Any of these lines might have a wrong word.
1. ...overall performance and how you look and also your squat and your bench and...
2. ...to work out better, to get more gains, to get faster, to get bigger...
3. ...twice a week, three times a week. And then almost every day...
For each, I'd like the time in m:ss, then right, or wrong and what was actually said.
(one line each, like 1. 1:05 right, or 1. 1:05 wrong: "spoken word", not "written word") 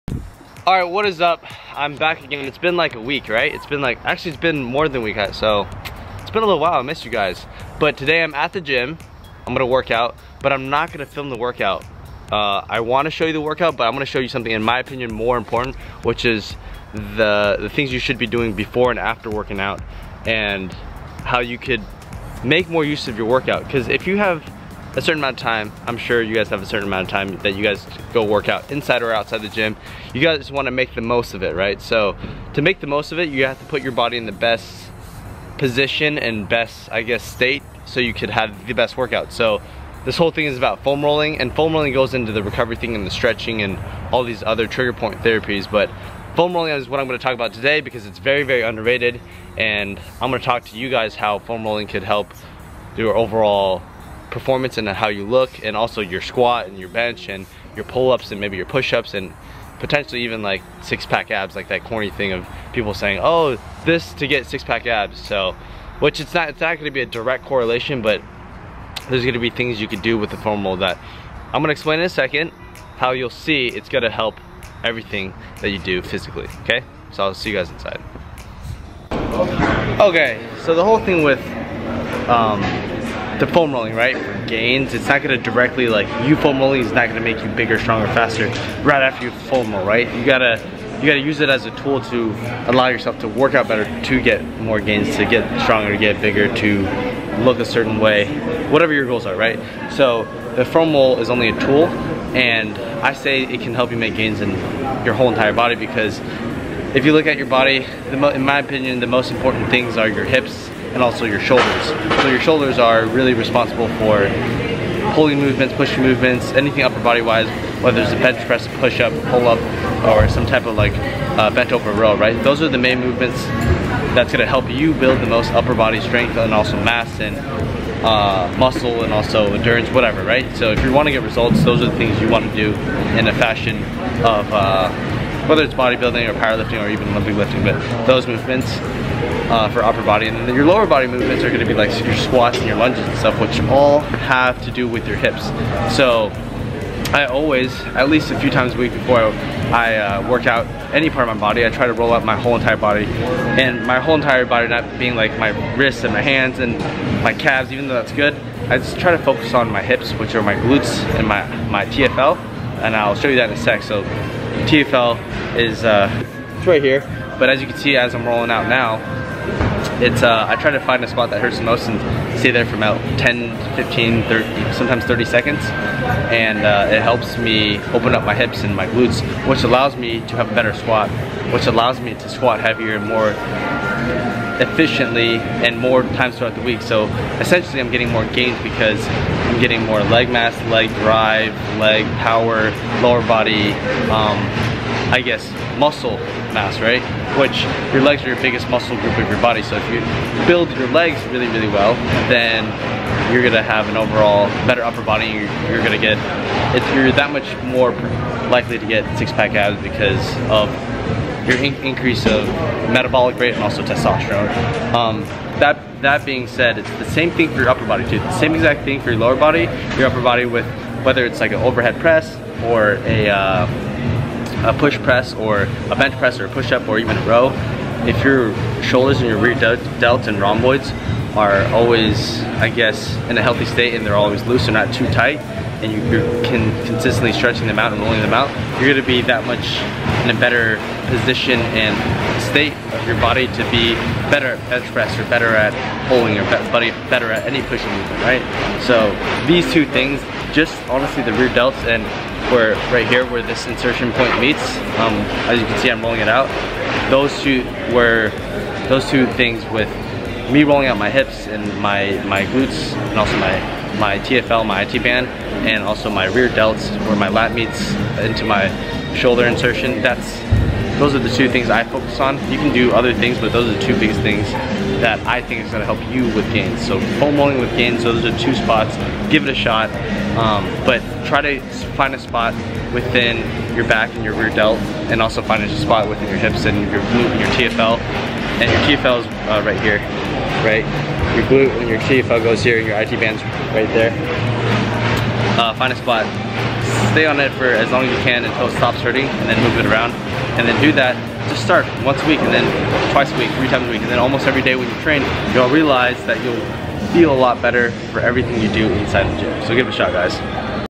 1. 0:53 right
2. 1:33 wrong: "stronger", not "faster"
3. 5:03 right.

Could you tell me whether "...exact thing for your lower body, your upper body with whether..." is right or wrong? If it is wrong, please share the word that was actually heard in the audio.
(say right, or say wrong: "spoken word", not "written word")
right.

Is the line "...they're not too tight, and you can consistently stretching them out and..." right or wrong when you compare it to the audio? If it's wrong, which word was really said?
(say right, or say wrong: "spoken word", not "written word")
right.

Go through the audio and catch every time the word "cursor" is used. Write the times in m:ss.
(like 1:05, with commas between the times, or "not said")
not said.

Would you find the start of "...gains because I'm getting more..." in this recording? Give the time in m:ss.
3:08.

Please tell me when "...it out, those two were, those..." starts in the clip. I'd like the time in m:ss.
4:16.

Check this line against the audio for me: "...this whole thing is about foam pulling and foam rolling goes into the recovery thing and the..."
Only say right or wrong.
wrong.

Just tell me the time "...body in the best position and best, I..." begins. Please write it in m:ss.
0:33.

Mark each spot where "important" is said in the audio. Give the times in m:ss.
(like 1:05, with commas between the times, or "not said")
0:15, 1:49.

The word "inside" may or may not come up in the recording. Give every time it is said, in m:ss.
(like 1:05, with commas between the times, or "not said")
0:28, 1:17, 5:08.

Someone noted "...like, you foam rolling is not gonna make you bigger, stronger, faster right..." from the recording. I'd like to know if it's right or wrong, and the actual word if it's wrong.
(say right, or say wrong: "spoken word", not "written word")
right.